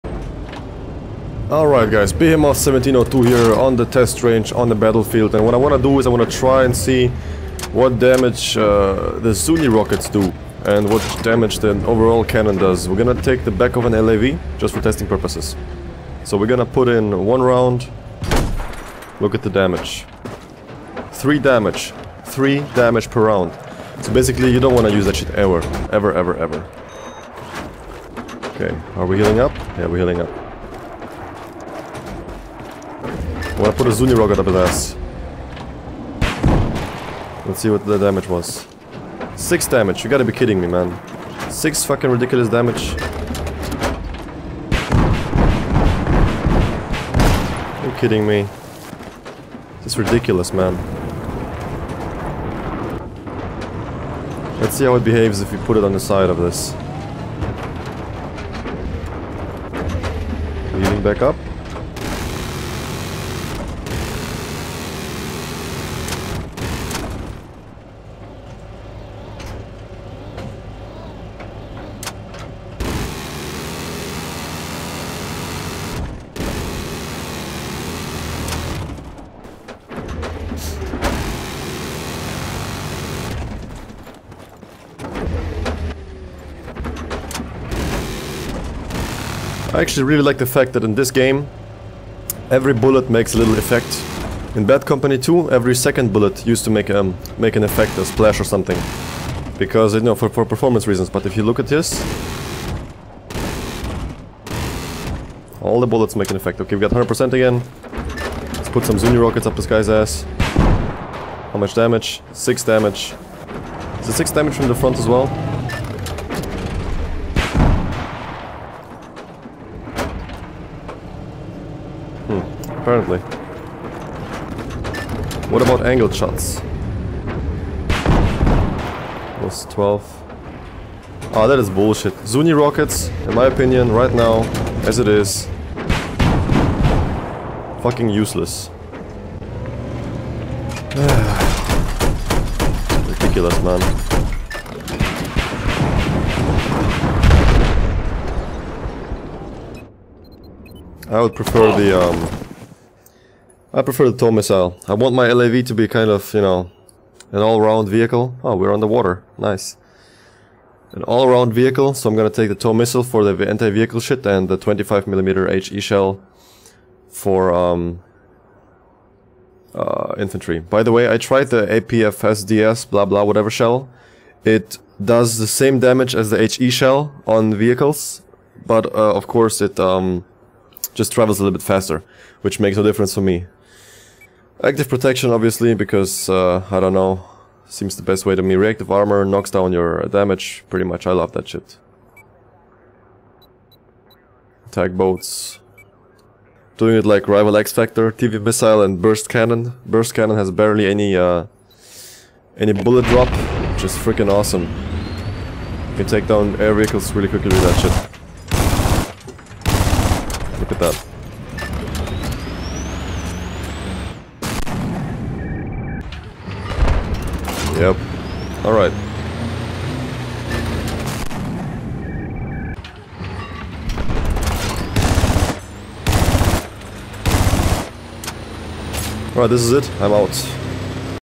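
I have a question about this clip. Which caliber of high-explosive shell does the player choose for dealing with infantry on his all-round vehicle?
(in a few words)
25mm.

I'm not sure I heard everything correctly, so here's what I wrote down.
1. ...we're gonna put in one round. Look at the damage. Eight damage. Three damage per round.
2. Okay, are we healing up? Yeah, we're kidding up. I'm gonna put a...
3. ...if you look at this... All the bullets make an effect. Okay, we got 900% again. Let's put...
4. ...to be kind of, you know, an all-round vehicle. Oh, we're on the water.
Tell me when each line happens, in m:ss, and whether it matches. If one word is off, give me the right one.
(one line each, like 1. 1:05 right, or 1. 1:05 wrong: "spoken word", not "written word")
1. 0:16 wrong: "Three", not "Eight"
2. 0:28 wrong: "healing", not "kidding"
3. 1:41 wrong: "100", not "900"
4. 2:35 right.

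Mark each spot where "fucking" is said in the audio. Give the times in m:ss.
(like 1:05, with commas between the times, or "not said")
0:41, 2:17.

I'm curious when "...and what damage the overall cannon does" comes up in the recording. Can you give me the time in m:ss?
0:10.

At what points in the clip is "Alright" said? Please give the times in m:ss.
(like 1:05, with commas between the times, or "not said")
0:01, 3:38, 3:49.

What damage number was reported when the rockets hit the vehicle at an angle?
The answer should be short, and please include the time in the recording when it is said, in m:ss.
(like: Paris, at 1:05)
12, at 2:09.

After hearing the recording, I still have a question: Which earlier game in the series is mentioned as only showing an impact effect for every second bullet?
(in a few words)
Bad Company 2.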